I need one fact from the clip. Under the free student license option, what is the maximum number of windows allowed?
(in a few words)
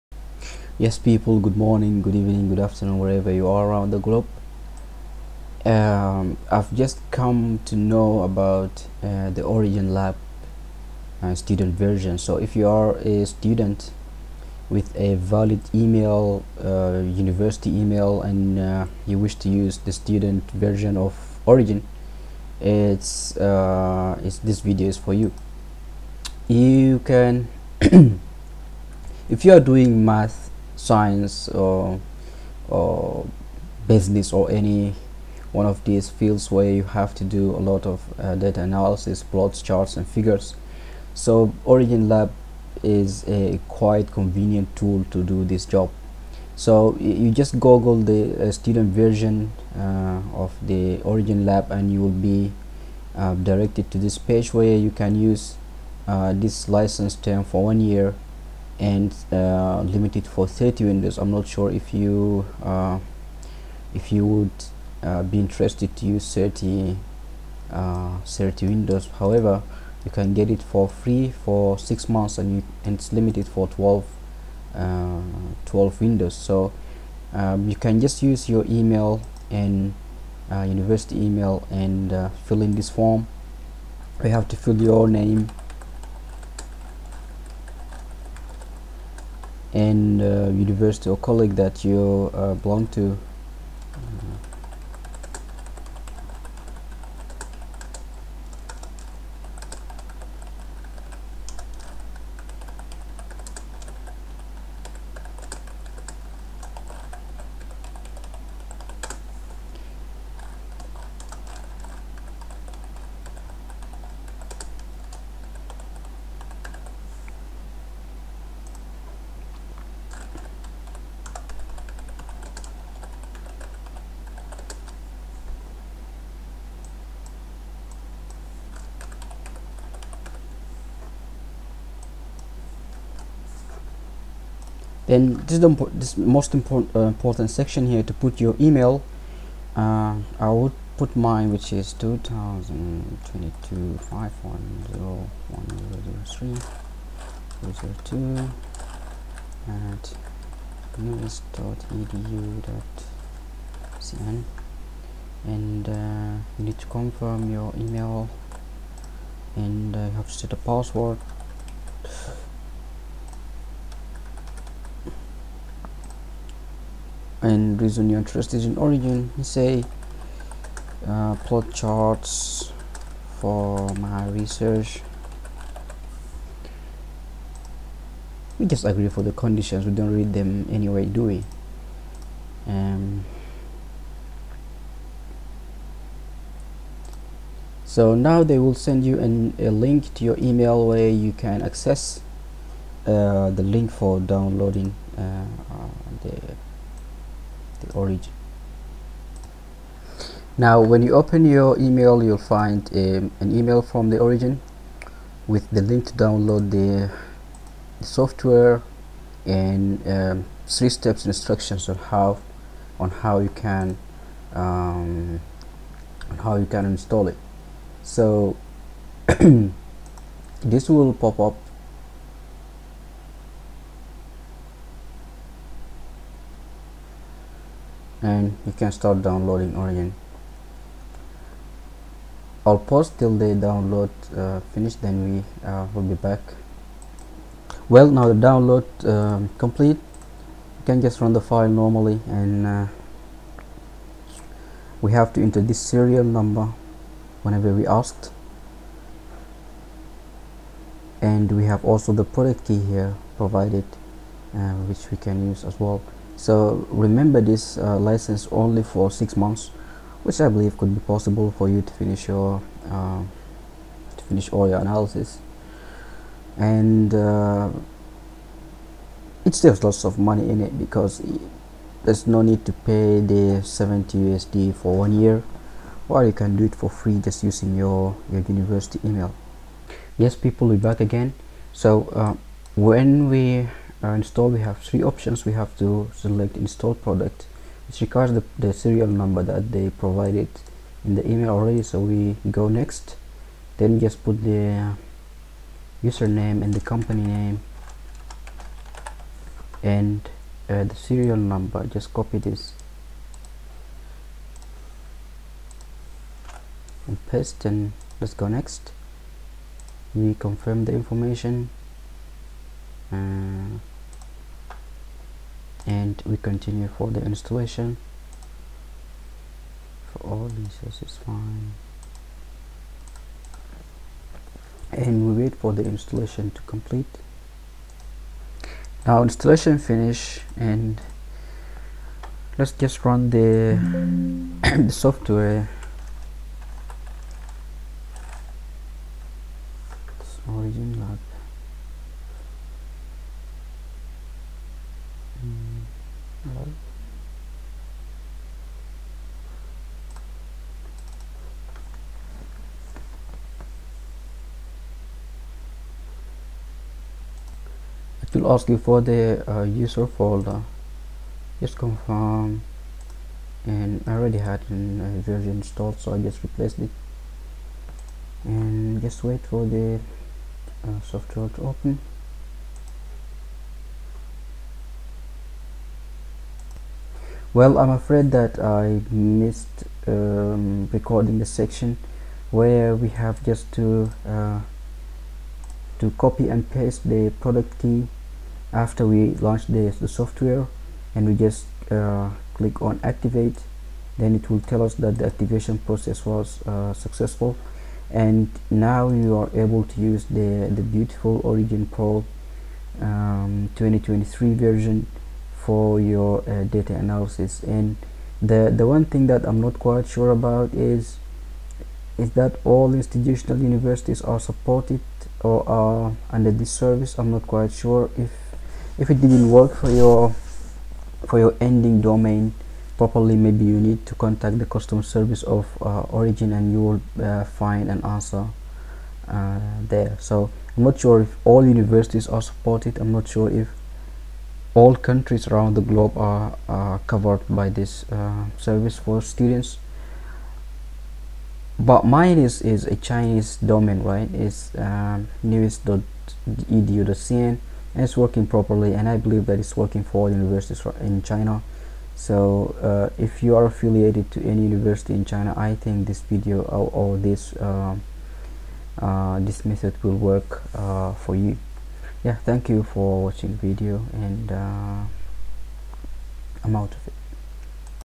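12.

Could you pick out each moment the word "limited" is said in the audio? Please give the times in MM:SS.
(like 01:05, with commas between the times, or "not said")
00:59, 01:13.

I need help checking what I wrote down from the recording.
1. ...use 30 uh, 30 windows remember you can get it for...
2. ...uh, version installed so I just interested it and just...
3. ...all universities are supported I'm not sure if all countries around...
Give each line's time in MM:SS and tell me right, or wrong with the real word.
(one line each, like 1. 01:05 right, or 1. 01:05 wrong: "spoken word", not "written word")
1. 01:06 wrong: "however", not "remember"
2. 06:05 wrong: "replaced", not "interested"
3. 07:11 right.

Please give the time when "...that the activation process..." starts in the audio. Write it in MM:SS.
06:34.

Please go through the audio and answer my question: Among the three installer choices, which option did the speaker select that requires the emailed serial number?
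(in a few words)
Install product.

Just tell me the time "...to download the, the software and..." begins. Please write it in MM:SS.
03:26.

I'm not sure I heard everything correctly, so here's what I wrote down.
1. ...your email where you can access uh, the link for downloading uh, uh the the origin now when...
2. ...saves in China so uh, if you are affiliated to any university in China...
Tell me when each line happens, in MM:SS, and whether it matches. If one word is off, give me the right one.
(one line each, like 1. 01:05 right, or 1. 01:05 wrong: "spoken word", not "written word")
1. 03:10 right
2. 07:30 wrong: "universities", not "saves".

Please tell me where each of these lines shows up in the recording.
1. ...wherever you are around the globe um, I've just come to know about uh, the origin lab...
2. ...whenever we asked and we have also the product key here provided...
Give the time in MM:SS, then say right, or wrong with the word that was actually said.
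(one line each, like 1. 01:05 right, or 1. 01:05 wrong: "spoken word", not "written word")
1. 00:02 right
2. 04:07 right.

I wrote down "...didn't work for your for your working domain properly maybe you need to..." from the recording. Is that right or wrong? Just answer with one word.
wrong.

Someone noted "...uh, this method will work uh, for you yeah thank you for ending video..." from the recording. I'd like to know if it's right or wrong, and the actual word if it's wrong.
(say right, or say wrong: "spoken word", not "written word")
wrong: "watching", not "ending".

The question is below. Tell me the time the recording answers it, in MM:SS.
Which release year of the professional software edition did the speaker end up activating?
06:43.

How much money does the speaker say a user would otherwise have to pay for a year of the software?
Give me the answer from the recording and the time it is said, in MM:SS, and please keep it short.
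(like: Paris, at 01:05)
70 USD, at 04:33.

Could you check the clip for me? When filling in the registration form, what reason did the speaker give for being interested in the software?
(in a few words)
Plot charts for my research.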